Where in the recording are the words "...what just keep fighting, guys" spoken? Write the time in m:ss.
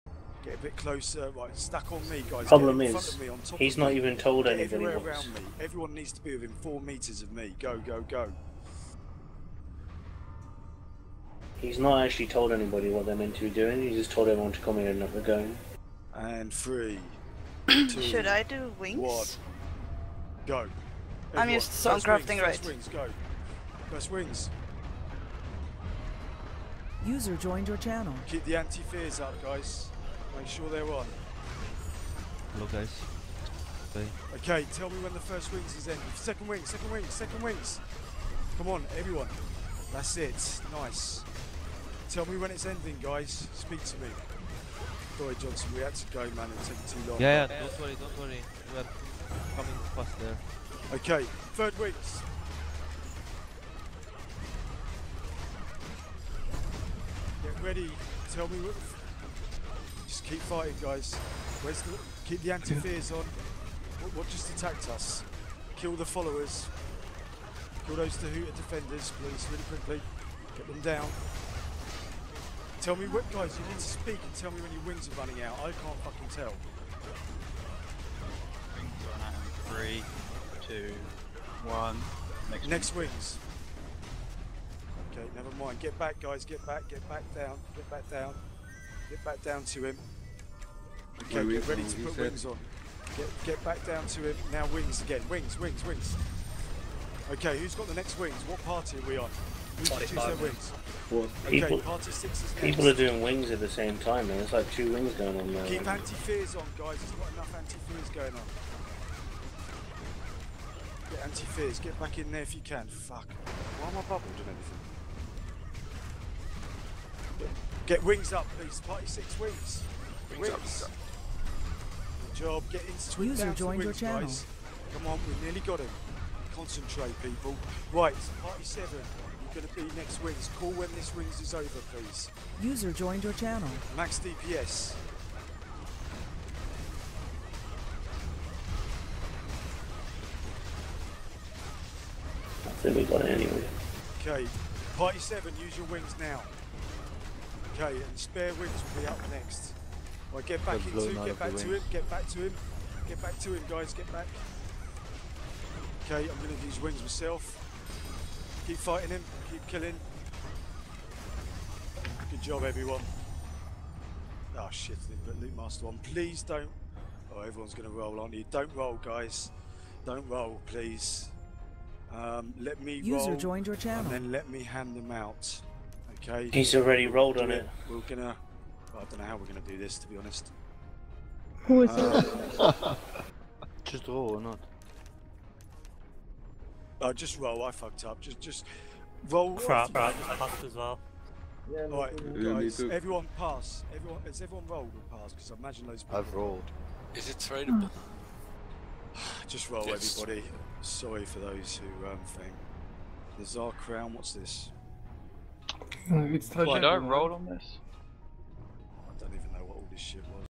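0:58.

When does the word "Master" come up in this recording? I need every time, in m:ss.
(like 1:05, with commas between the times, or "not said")
2:45.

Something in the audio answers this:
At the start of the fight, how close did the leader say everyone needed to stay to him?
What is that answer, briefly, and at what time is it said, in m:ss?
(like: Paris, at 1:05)
4 meters, at 0:06.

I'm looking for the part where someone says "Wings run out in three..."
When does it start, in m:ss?
1:18.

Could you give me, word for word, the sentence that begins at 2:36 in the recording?
Okay, I'm going to use wings myself.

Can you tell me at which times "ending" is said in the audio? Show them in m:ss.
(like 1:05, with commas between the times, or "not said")
0:35, 0:42.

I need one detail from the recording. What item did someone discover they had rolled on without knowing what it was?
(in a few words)
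The Tsar Crown.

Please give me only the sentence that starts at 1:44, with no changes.
It's like two wings going on there.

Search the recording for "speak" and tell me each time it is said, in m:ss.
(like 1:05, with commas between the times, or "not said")
0:43, 1:13.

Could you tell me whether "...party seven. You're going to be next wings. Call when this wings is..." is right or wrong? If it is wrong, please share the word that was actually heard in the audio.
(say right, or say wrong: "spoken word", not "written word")
right.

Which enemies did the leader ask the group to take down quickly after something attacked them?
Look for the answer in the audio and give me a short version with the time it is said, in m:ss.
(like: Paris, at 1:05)
Dahuta defenders, at 1:08.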